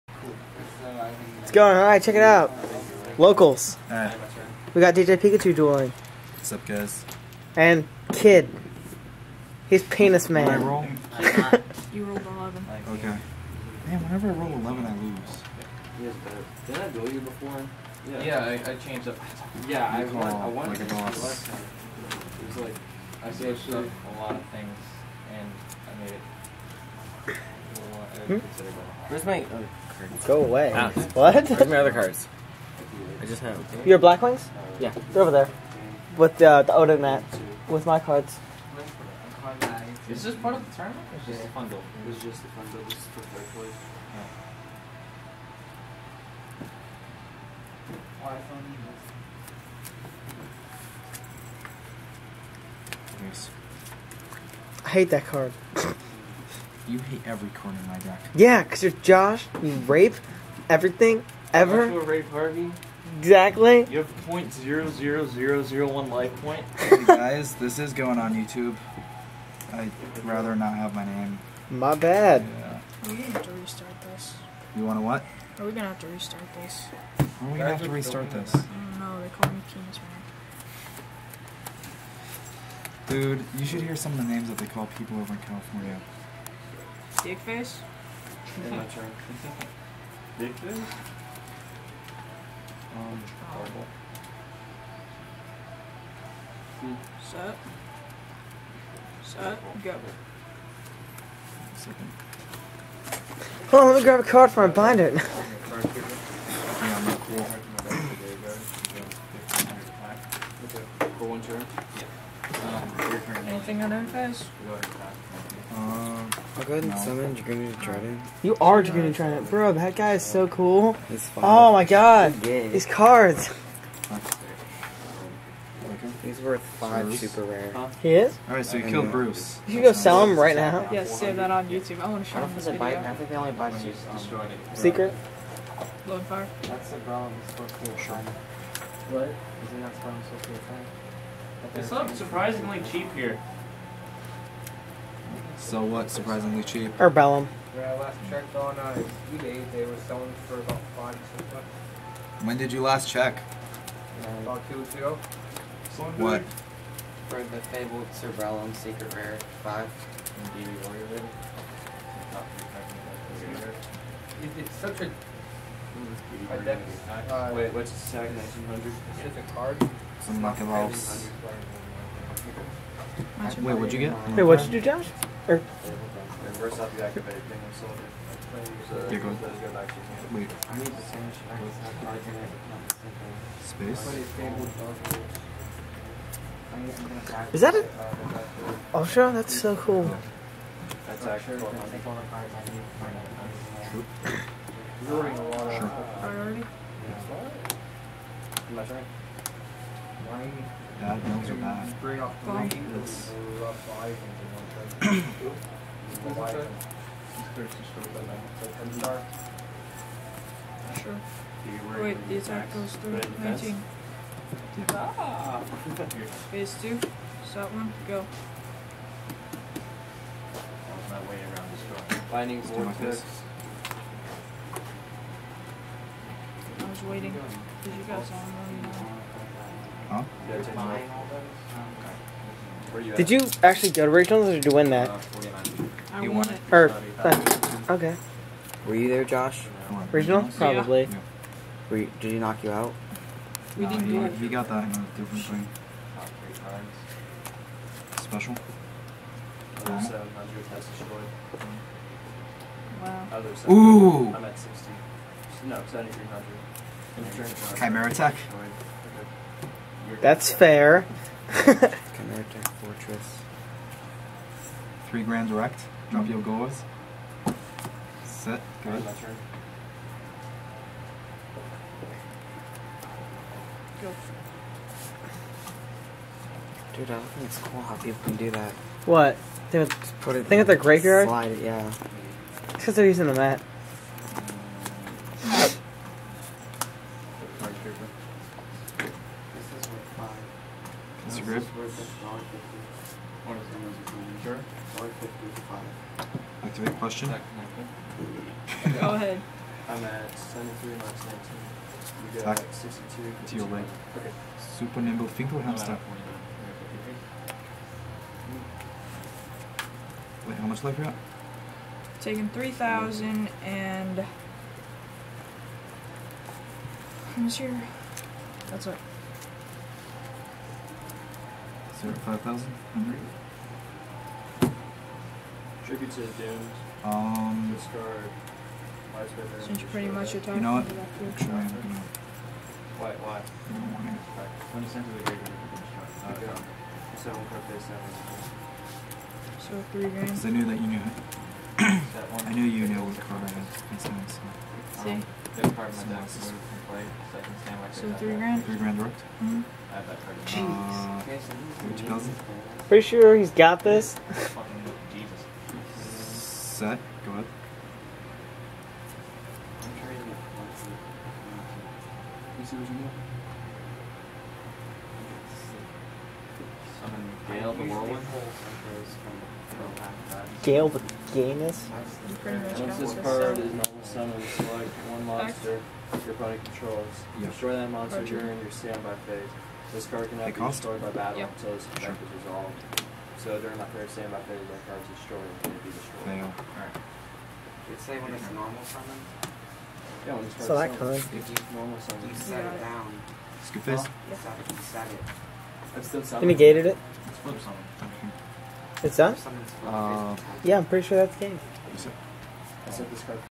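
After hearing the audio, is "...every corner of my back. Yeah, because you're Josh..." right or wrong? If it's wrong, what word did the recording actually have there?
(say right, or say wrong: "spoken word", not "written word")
right.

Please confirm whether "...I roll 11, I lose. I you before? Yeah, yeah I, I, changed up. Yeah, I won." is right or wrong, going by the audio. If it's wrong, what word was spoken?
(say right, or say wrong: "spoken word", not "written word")
right.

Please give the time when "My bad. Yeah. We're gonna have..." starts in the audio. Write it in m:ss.
1:11.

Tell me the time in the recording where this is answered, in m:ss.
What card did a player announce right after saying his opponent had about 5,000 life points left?
5:25.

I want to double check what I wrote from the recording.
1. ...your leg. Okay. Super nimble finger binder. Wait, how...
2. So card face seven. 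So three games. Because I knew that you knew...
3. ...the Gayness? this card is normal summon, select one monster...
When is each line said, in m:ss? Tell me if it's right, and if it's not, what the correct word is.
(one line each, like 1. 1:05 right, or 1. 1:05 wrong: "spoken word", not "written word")
1. 5:03 wrong: "hamster", not "binder"
2. 5:37 right
3. 6:10 right.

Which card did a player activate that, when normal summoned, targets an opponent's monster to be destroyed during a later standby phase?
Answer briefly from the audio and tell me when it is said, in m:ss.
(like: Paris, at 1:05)
Gale the Whirlwind, at 6:07.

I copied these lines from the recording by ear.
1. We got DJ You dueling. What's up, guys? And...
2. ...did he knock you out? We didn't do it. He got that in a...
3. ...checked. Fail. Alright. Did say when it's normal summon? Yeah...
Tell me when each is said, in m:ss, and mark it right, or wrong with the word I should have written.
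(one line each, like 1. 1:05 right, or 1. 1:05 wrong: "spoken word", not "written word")
1. 0:04 wrong: "Pikachu", not "You"
2. 4:02 right
3. 6:25 wrong: "destroyed", not "checked".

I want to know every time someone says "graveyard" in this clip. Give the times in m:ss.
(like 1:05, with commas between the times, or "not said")
4:40, 5:35.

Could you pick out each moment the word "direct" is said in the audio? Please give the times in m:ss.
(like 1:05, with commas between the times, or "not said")
4:25.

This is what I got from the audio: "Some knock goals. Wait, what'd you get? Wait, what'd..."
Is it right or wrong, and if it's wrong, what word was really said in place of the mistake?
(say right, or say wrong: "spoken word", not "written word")
wrong: "rolls", not "goals".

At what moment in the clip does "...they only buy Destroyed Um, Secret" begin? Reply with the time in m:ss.
2:13.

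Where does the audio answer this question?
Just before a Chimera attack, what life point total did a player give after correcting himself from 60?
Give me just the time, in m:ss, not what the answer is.
4:15.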